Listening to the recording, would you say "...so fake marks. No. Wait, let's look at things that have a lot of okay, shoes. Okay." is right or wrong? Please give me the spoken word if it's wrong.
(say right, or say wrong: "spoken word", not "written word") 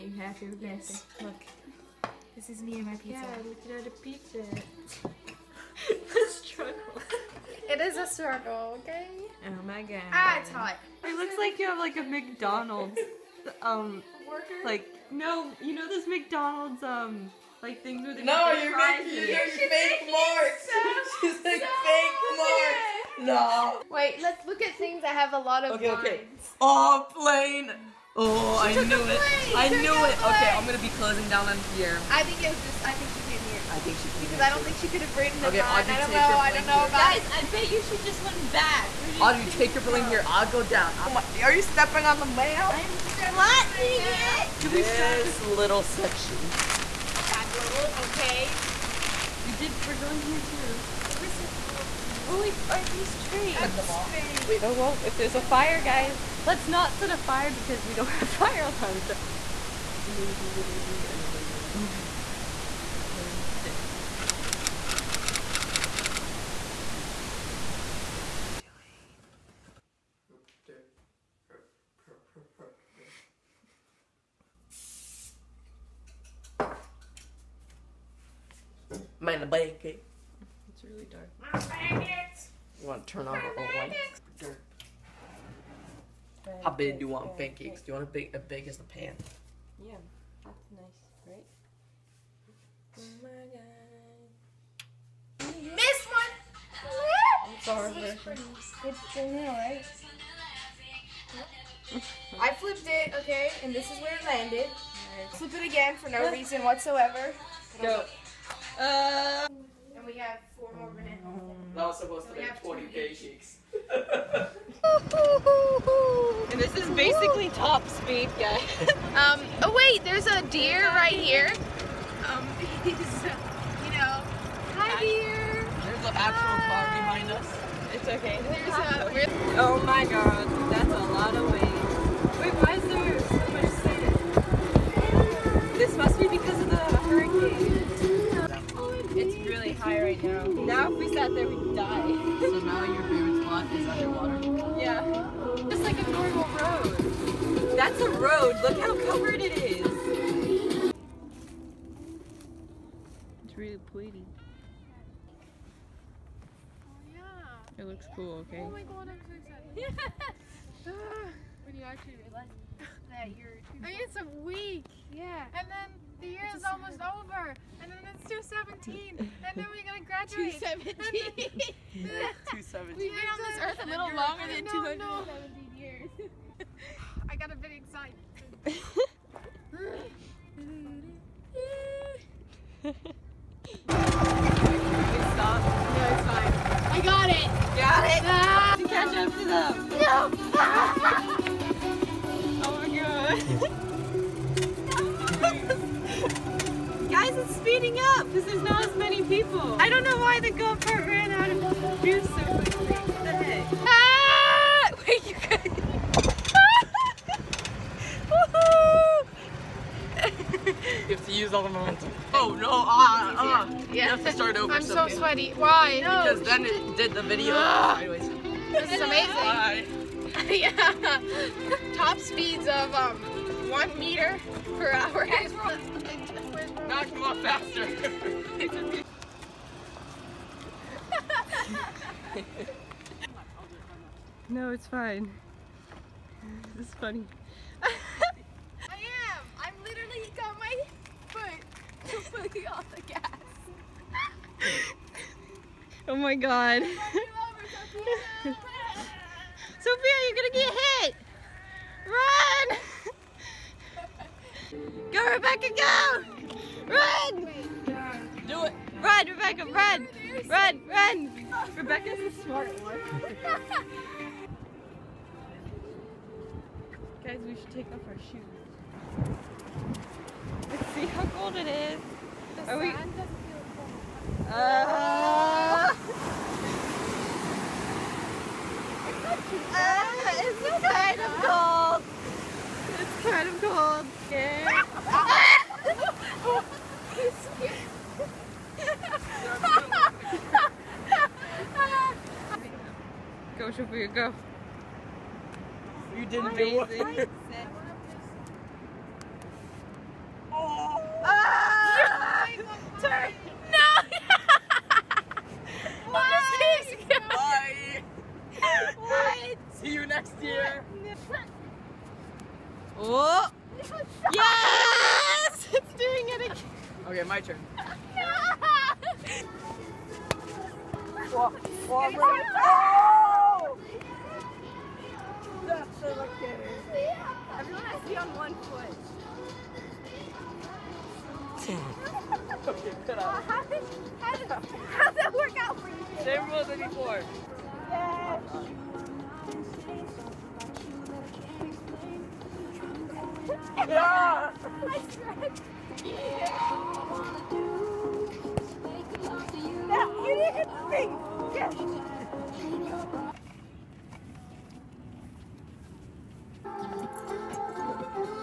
wrong: "lines", not "shoes".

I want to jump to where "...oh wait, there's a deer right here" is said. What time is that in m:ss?
1:59.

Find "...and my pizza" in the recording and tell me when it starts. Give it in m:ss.
0:02.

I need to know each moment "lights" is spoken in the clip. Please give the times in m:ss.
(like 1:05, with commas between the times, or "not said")
1:23.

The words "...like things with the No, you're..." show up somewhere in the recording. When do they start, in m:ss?
0:17.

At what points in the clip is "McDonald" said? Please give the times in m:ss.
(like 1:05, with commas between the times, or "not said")
0:12, 0:16.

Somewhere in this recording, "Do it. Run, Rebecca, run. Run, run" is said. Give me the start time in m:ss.
4:18.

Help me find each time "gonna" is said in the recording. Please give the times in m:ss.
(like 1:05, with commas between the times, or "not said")
0:30, 2:49, 4:10.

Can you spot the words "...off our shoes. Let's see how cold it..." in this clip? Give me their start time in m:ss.
4:27.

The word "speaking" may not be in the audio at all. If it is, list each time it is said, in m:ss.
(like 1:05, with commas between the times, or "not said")
not said.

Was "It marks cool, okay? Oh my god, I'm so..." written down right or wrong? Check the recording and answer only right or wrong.
wrong.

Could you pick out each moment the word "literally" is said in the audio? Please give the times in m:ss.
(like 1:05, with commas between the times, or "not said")
1:00, 3:59.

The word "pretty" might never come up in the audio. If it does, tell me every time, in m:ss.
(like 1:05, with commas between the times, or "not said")
2:33.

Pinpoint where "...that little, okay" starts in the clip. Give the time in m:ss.
0:47.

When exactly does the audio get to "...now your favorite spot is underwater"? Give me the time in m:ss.
2:22.